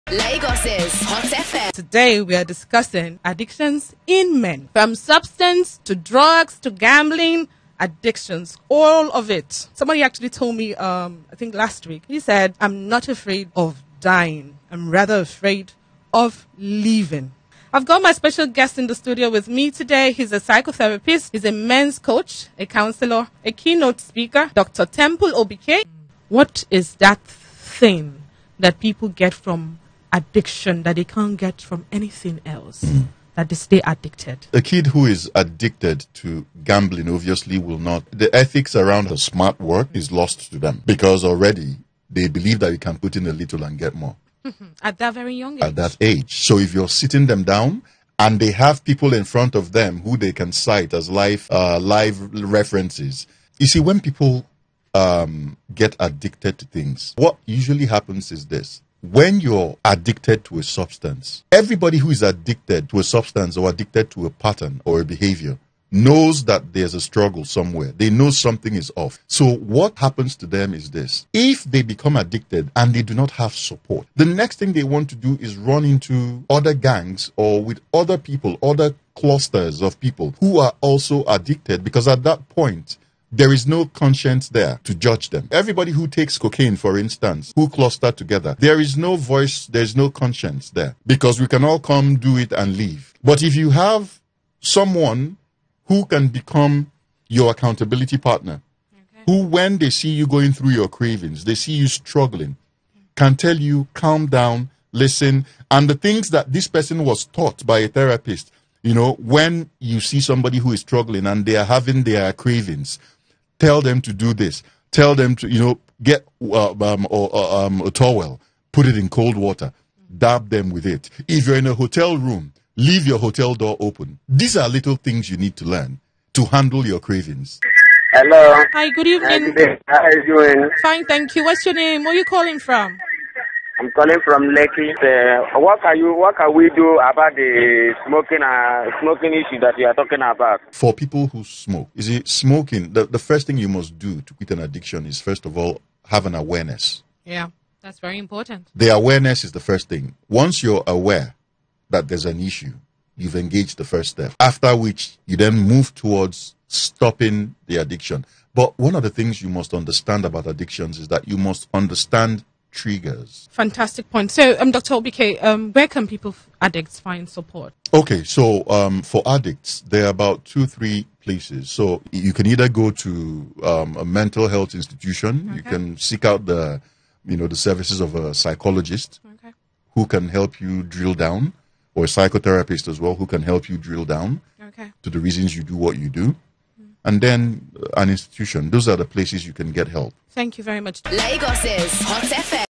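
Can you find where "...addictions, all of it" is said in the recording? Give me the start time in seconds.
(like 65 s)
7 s.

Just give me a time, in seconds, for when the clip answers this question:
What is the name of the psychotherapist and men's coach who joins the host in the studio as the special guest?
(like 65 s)
24 s.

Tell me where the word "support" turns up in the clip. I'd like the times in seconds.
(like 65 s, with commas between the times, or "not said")
73 s, 167 s.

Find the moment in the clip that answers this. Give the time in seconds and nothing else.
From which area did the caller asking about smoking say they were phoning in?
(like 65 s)
134 s.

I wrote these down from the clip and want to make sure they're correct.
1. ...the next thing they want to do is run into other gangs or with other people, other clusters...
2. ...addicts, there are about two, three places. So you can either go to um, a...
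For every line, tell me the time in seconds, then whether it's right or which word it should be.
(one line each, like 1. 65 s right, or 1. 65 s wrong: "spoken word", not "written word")
1. 74 s right
2. 169 s right.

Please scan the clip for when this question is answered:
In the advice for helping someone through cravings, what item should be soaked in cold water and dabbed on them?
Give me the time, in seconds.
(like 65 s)
117 s.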